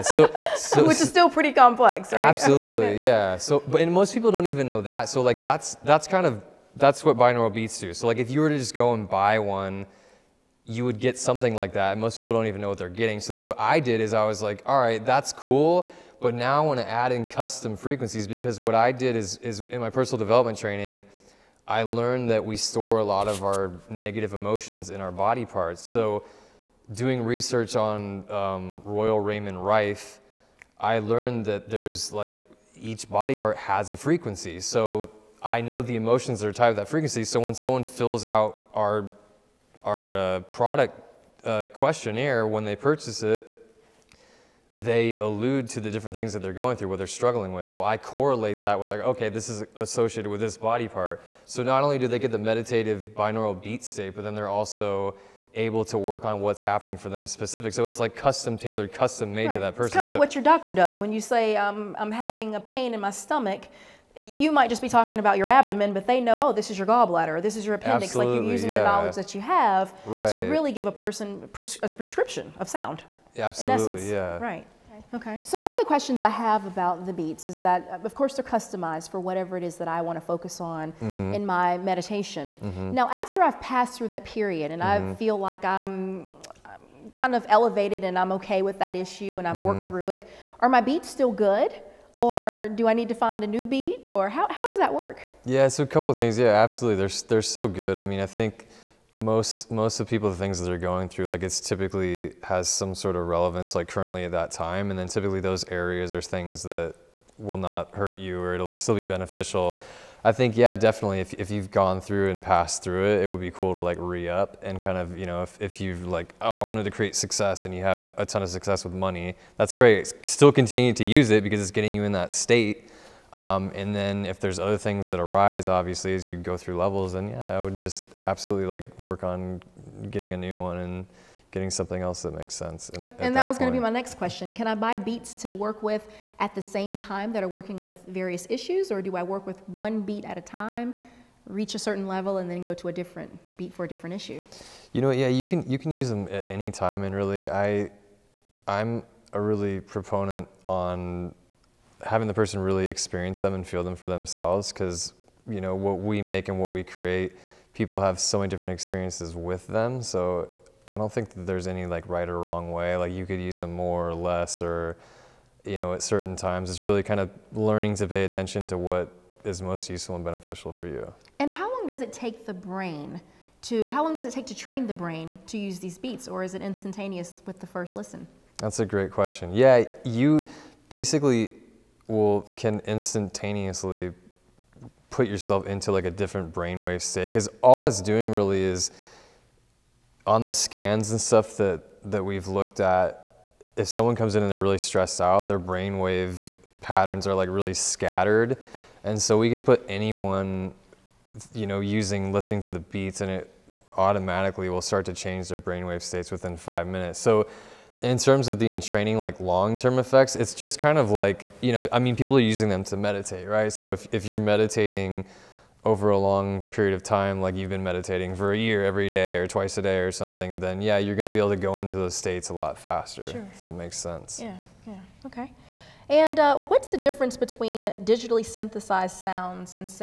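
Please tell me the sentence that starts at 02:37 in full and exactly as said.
People have so many different experiences with them, so I don't think there's any like right or wrong way.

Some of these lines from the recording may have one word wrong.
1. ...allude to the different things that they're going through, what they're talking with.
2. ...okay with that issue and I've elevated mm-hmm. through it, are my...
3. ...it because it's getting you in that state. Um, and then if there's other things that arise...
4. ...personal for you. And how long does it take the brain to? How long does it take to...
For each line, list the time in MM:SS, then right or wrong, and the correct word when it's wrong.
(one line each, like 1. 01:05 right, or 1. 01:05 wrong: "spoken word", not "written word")
1. 00:45 wrong: "struggling", not "talking"
2. 01:28 wrong: "worked", not "elevated"
3. 02:01 right
4. 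02:50 wrong: "beneficial", not "personal".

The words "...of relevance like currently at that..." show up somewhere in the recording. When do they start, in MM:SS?
01:43.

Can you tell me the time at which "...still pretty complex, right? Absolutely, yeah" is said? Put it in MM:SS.
00:01.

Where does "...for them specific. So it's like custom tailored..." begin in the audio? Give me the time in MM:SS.
00:56.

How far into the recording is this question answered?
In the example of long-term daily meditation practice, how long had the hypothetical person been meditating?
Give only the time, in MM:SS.
03:38.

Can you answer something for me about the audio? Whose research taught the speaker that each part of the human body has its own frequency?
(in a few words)
Royal Raymond Rife.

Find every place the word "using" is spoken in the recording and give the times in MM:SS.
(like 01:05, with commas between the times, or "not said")
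01:08, 03:21, 03:32.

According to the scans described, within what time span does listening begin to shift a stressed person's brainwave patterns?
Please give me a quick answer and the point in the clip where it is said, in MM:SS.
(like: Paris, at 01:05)
5 minutes, at 03:26.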